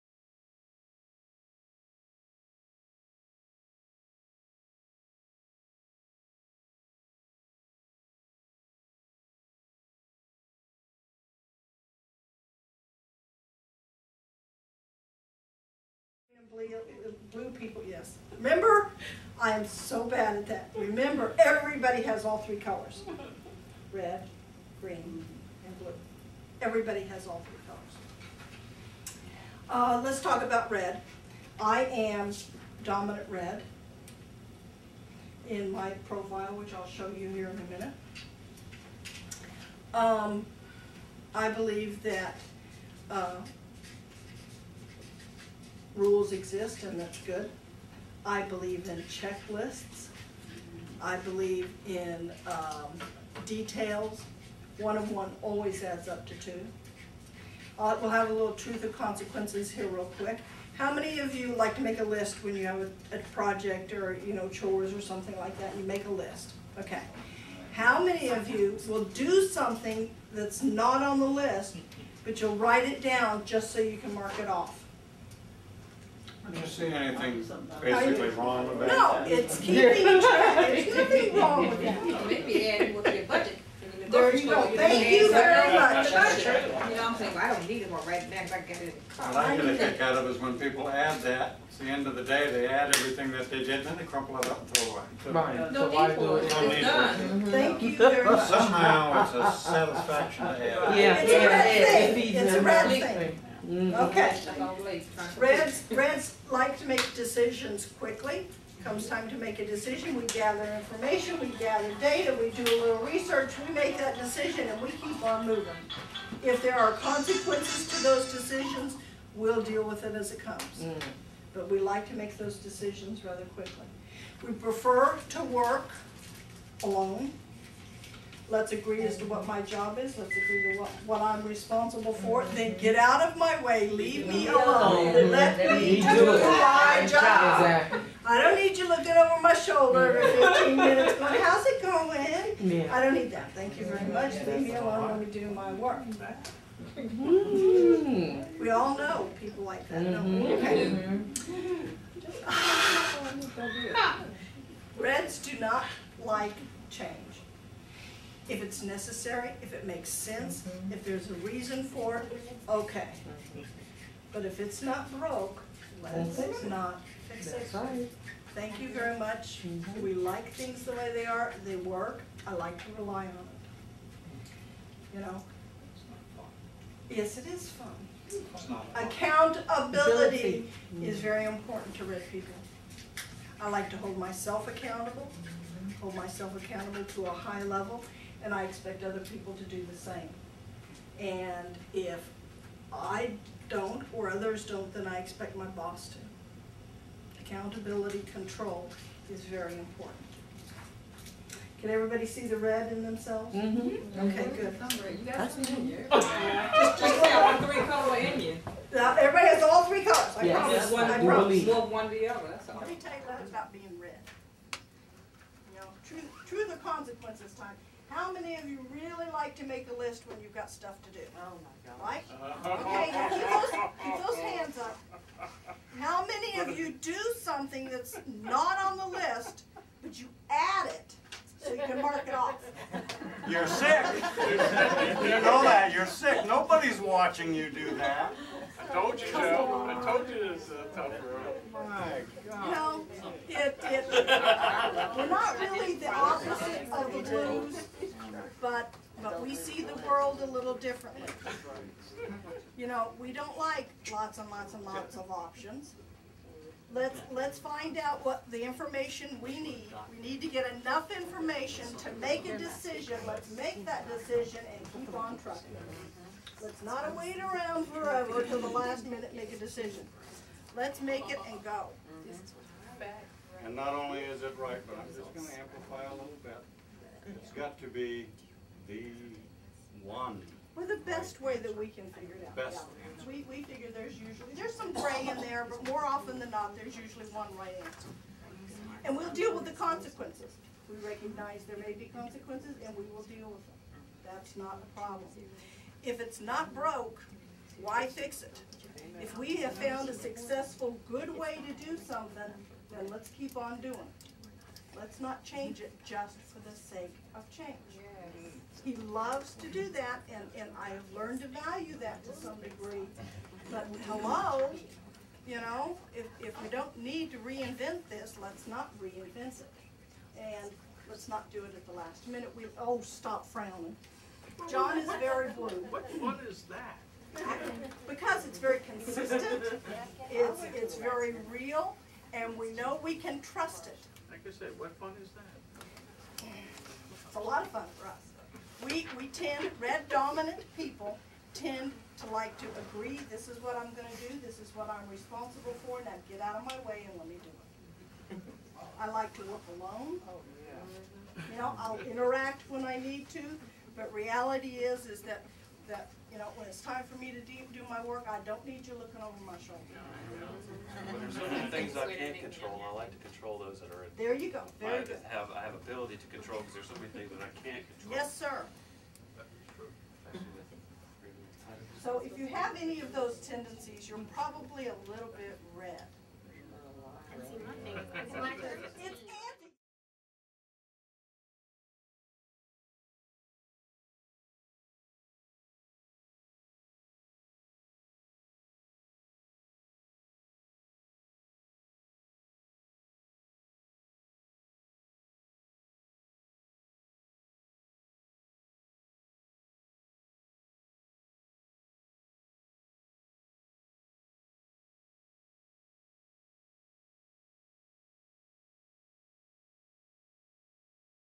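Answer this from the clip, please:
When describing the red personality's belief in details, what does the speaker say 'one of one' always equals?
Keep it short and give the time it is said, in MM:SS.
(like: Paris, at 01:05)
2, at 00:56.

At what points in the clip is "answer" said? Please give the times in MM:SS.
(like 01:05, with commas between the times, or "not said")
04:47.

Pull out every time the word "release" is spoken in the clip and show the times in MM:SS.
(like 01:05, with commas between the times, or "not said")
not said.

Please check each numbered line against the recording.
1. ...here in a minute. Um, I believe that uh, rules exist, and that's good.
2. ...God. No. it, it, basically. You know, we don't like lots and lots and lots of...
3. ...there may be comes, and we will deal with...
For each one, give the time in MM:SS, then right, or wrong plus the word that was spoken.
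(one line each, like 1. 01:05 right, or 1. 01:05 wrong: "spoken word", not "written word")
1. 00:37 right
2. 04:02 wrong: "differently", not "basically"
3. 04:51 wrong: "consequences", not "comes".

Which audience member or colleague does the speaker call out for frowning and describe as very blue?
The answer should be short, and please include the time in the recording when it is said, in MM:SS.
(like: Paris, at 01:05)
John, at 05:24.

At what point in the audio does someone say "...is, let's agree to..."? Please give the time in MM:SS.
02:09.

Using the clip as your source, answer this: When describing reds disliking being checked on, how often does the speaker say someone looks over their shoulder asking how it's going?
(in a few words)
every 15 minutes.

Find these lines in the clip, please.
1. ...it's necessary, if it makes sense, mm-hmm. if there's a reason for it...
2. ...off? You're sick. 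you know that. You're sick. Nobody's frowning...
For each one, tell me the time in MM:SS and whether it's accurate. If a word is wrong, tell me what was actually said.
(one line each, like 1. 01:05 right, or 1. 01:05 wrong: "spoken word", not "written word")
1. 02:38 right
2. 03:52 wrong: "watching", not "frowning".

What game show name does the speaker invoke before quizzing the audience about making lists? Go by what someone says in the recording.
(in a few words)
Truth or Consequences.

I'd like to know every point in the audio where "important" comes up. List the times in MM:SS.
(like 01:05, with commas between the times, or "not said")
03:01, 03:19.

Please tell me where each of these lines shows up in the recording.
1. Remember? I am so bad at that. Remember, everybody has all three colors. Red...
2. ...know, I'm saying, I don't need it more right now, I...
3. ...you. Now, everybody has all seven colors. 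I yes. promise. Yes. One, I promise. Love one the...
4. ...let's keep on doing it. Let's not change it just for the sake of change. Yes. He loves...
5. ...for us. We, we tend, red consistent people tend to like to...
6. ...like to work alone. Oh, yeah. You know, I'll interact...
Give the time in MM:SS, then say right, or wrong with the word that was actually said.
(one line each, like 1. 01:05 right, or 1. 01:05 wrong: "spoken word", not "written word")
1. 00:18 right
2. 01:26 right
3. 03:28 wrong: "three", not "seven"
4. 05:03 right
5. 05:37 wrong: "dominant", not "consistent"
6. 05:49 right.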